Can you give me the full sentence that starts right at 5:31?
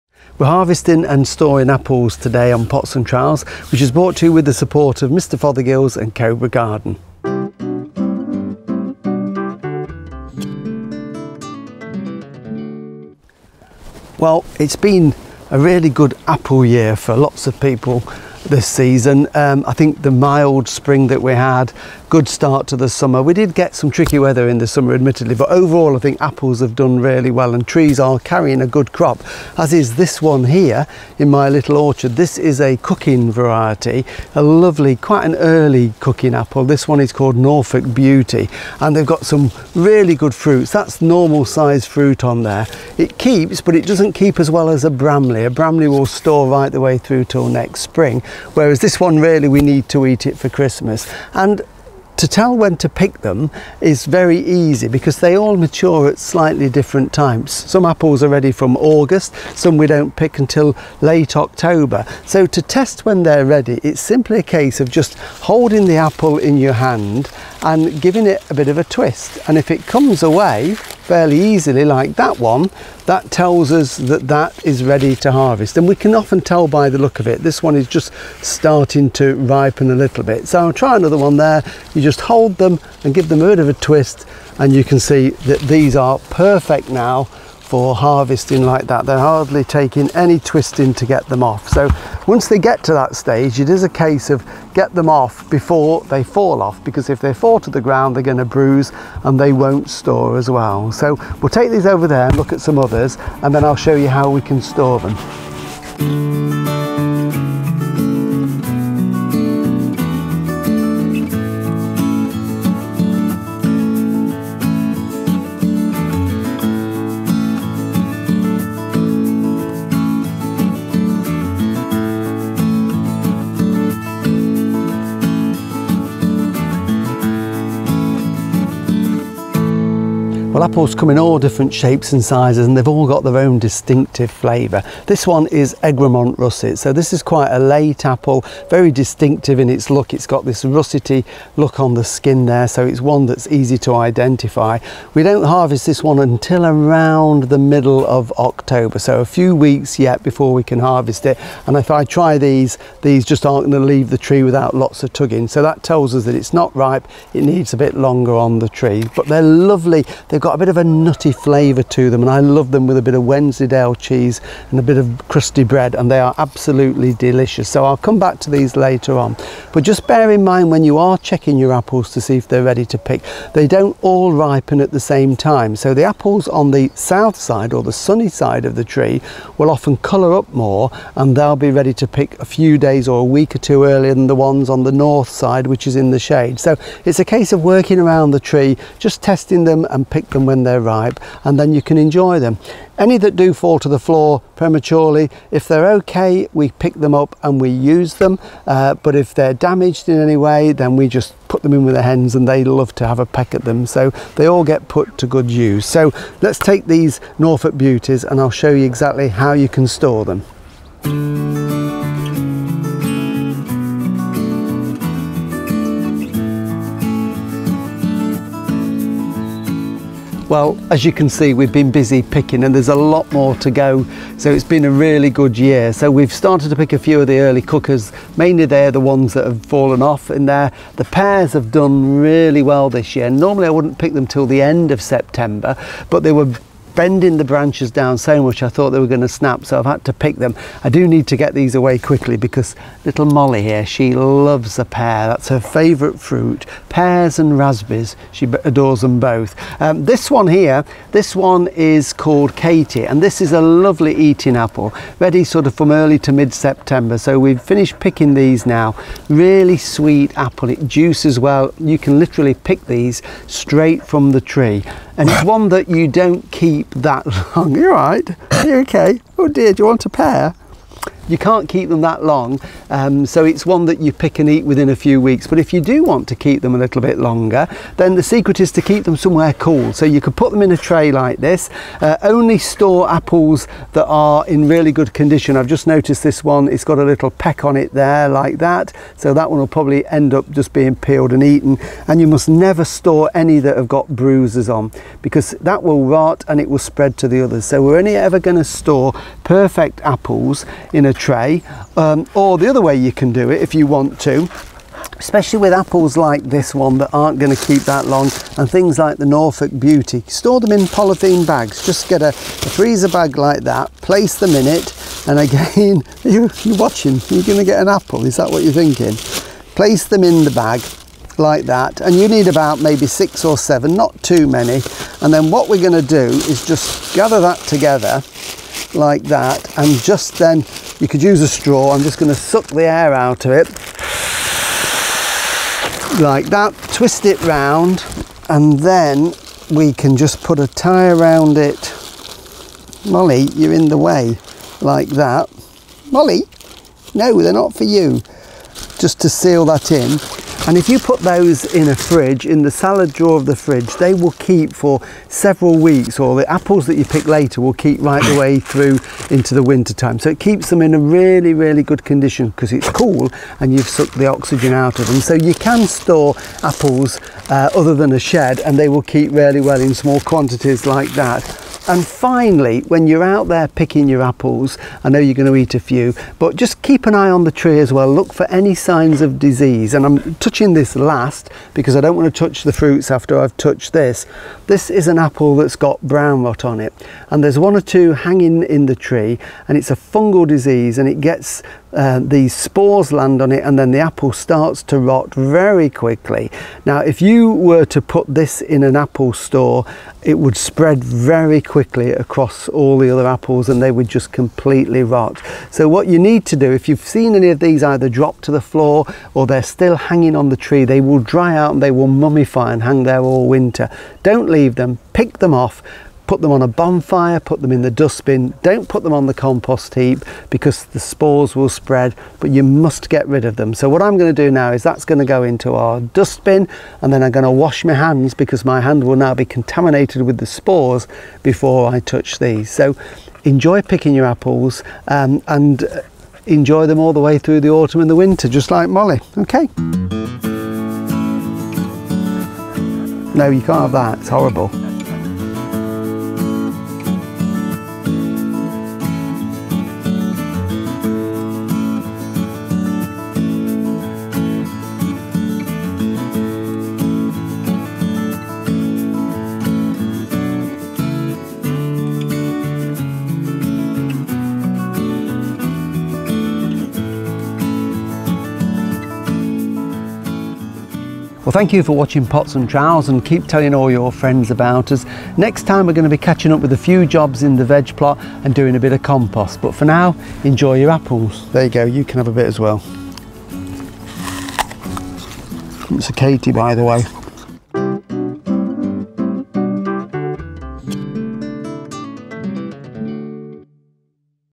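I'm just going to suck the air out of it like that.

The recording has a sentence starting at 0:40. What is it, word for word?
That's normal size fruit on there.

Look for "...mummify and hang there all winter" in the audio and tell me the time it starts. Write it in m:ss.
6:52.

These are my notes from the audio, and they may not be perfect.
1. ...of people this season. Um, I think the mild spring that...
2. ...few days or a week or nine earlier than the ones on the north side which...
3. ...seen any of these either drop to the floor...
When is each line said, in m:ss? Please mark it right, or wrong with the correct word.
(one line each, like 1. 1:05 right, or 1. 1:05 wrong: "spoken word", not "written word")
1. 0:17 right
2. 3:02 wrong: "two", not "nine"
3. 6:47 right.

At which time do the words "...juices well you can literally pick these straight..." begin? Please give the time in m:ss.
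4:20.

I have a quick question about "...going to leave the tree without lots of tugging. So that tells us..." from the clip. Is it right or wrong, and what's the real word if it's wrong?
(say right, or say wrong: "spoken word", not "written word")
right.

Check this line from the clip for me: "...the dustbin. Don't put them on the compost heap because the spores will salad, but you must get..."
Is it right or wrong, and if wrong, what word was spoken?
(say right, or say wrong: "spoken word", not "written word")
wrong: "spread", not "salad".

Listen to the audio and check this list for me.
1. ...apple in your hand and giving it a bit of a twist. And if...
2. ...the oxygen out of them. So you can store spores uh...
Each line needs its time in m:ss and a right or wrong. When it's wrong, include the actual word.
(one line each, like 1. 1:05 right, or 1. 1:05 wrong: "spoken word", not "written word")
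1. 1:05 right
2. 6:04 wrong: "apples", not "spores".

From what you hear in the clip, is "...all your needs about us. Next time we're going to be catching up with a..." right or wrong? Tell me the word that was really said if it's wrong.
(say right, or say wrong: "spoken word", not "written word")
wrong: "friends", not "needs".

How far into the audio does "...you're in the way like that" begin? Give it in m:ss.
5:43.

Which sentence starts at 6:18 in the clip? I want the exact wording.
Look for any signs of disease.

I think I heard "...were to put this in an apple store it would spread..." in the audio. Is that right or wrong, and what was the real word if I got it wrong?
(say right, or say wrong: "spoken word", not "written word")
right.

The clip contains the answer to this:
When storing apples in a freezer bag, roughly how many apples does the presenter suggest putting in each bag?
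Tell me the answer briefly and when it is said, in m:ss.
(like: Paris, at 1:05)
6 or 7, at 5:23.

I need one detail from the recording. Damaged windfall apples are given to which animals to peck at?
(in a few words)
hens.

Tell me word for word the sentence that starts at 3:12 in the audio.
Any that do fall to the floor prematurely, if they're okay, we pick them up and we use them.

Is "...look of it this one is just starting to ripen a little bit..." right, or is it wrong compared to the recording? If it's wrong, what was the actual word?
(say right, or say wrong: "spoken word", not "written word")
right.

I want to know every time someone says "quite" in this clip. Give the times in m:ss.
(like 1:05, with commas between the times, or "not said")
0:34, 2:17.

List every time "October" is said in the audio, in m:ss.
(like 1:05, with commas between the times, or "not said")
1:01, 2:28.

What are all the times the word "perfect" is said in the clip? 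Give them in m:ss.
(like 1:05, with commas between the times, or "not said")
1:26, 4:59.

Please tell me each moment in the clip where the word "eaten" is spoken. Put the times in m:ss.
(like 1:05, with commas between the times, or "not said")
4:51.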